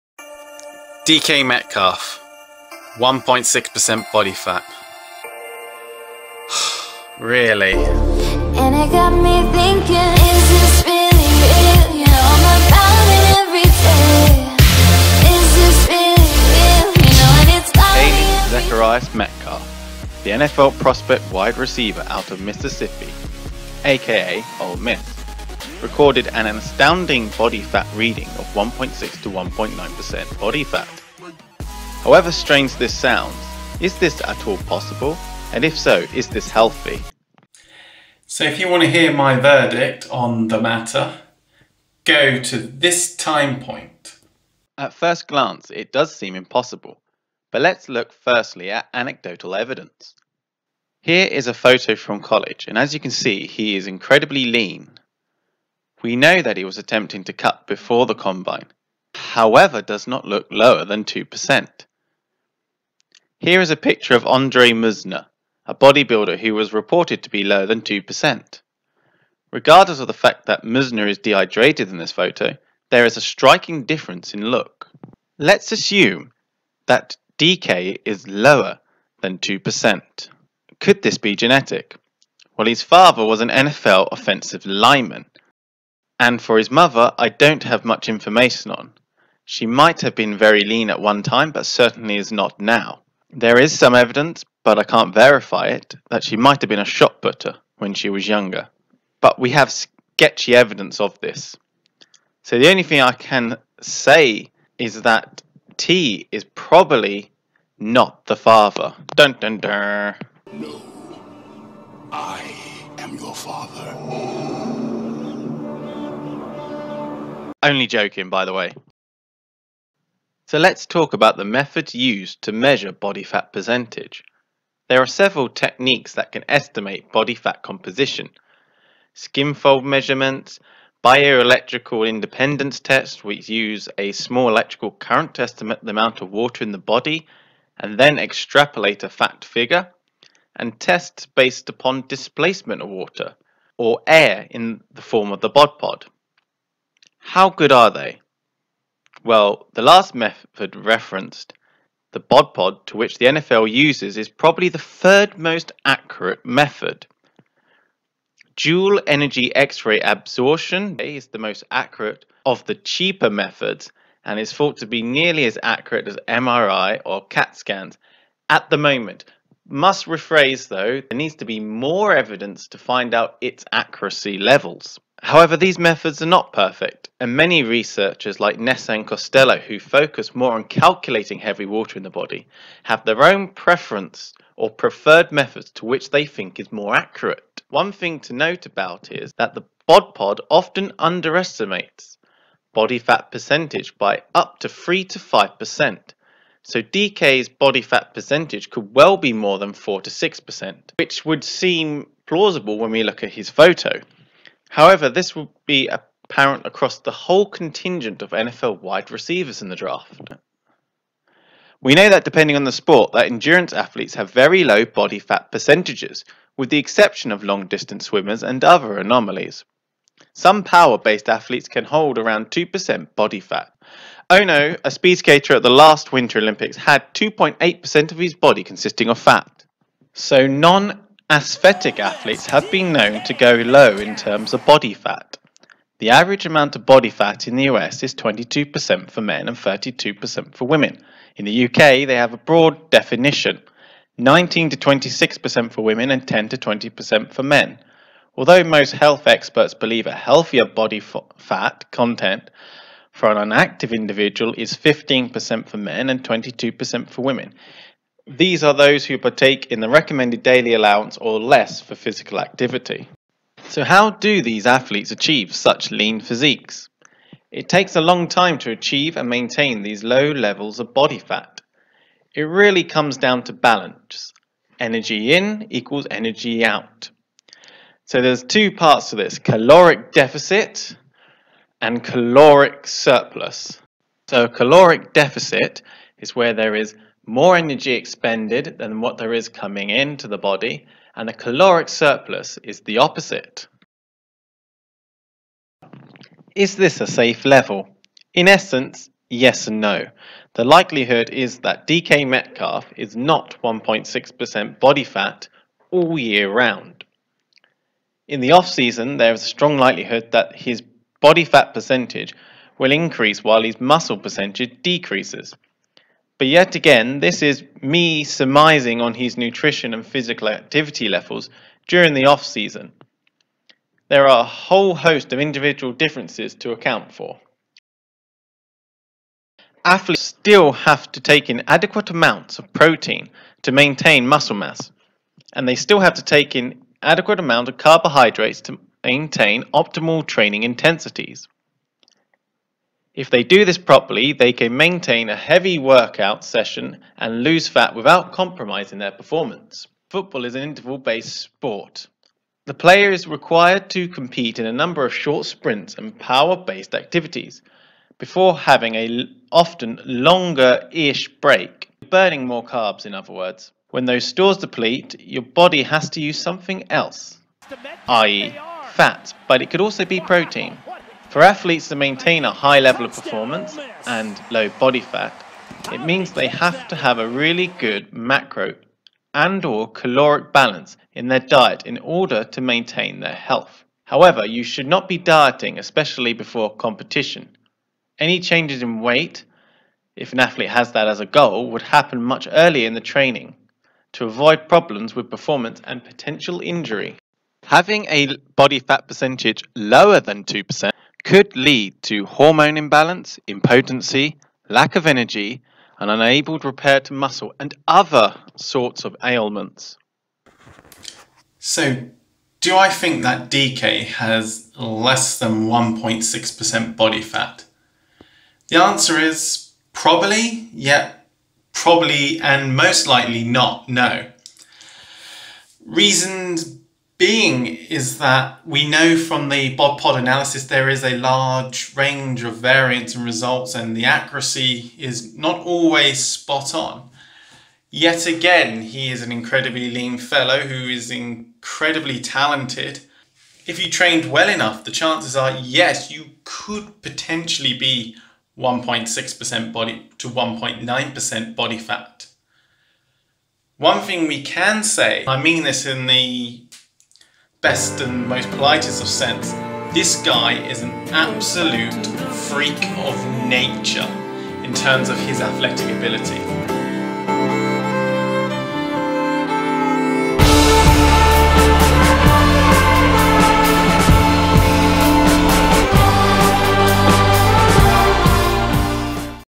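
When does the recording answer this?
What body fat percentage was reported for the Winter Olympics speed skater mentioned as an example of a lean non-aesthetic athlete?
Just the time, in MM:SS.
03:47.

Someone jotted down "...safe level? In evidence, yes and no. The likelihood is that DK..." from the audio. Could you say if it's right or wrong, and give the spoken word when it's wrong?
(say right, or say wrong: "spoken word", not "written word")
wrong: "essence", not "evidence".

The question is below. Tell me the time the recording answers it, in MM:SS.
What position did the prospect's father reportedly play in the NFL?
01:24.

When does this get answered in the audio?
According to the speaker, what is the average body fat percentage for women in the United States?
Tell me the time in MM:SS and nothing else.
03:59.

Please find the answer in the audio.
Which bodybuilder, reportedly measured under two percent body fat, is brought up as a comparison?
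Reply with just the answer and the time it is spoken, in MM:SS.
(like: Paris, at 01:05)
Andre Munzer, at 01:04.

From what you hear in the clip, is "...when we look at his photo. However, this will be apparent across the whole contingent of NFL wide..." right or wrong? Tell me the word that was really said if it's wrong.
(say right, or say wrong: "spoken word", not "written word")
right.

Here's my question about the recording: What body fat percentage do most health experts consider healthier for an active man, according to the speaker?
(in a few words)
15%.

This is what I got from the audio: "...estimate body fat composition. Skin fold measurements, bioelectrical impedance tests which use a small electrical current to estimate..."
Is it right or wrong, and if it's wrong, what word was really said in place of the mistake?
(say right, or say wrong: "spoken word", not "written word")
right.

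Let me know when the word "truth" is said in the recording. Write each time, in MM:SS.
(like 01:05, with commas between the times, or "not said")
not said.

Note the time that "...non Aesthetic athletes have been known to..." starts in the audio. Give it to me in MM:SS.
03:50.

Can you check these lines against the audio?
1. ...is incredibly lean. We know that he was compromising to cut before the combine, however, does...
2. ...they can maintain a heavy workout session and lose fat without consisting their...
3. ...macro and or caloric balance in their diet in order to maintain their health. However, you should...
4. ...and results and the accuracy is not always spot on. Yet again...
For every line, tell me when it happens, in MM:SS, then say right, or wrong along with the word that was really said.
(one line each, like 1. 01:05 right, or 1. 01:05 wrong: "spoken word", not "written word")
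1. 00:53 wrong: "attempting", not "compromising"
2. 05:44 wrong: "compromising", not "consisting"
3. 06:18 right
4. 07:13 right.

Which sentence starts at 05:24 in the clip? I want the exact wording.
There are a whole host of individual differences to account for.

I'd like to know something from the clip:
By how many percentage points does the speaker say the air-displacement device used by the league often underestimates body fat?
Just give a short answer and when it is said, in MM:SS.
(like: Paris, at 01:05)
3 to 5%, at 03:14.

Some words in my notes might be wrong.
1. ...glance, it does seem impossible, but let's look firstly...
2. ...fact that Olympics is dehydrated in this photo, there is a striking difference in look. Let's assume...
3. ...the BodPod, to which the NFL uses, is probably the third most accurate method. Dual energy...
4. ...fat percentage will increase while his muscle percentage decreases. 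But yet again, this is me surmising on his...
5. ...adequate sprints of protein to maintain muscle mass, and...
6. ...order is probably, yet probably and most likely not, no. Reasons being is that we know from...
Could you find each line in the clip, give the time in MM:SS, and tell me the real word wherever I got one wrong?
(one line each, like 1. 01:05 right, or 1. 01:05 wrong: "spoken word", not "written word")
1. 00:45 right
2. 01:10 wrong: "Munzer", not "Olympics"
3. 02:32 right
4. 05:11 right
5. 05:31 wrong: "amounts", not "sprints"
6. 06:58 wrong: "answer", not "order".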